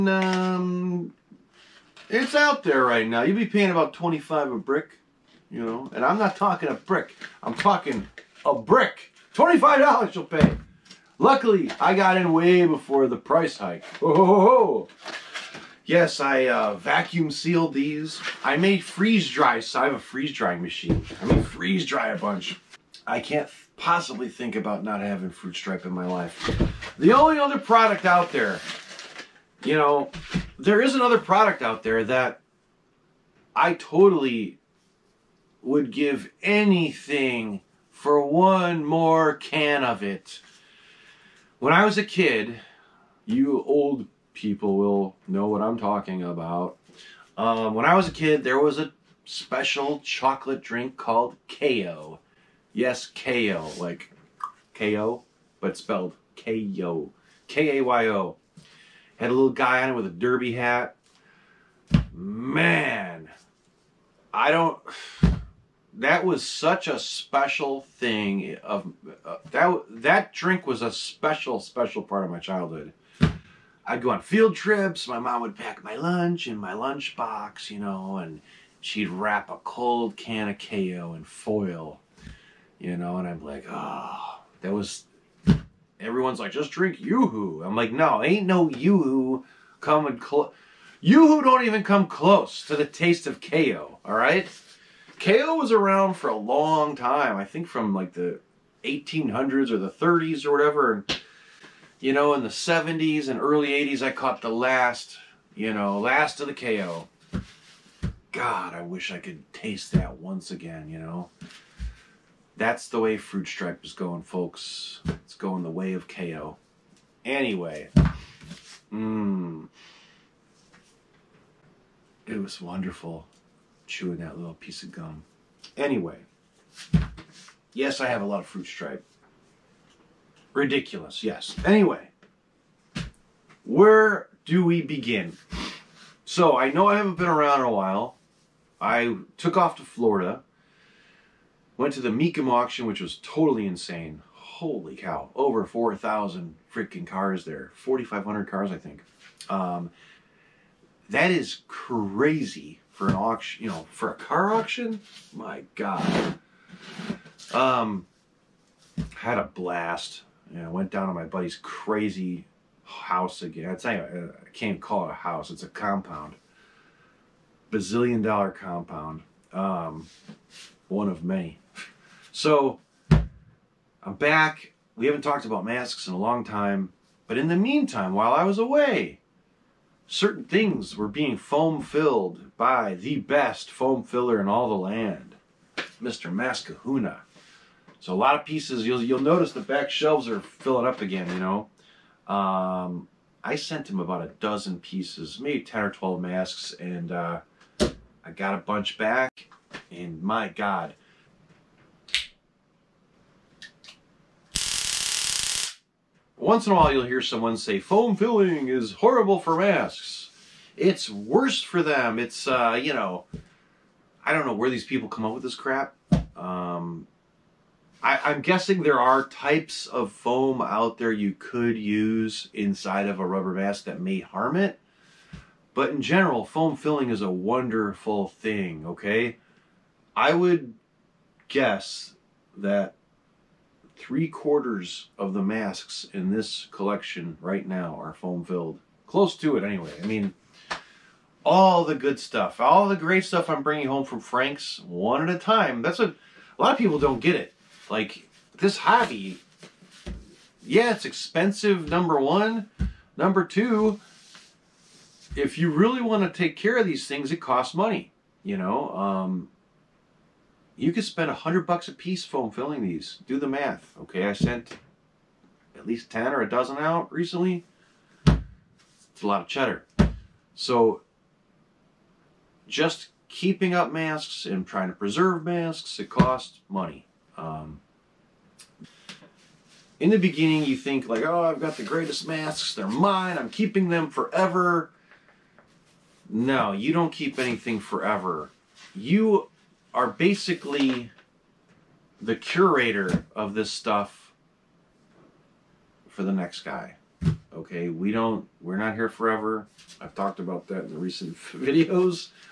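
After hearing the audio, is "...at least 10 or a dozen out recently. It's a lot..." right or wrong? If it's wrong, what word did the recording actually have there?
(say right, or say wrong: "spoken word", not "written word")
right.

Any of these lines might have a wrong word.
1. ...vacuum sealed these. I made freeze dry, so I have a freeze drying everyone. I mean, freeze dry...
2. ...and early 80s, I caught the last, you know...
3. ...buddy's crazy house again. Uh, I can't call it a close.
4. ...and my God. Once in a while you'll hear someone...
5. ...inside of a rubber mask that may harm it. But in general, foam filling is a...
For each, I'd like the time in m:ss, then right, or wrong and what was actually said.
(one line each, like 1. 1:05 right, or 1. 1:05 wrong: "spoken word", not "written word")
1. 0:16 wrong: "machine", not "everyone"
2. 1:43 right
3. 2:41 wrong: "house", not "close"
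4. 3:19 right
5. 3:42 right.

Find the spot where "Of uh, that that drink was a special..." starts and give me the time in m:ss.
1:08.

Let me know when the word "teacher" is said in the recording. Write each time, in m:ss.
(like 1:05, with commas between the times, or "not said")
not said.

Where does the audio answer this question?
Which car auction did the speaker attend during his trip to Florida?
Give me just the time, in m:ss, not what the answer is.
2:22.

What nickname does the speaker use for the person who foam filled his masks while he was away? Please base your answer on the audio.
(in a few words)
Mr. Maskahuna.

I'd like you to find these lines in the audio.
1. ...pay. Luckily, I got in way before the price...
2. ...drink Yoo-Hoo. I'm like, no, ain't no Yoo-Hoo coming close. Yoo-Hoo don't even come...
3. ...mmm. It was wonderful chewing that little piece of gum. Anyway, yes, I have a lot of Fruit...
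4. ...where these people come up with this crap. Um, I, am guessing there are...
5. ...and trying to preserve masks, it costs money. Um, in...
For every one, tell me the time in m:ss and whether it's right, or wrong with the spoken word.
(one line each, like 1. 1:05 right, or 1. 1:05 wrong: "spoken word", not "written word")
1. 0:10 right
2. 1:26 right
3. 1:58 right
4. 3:34 right
5. 4:34 right.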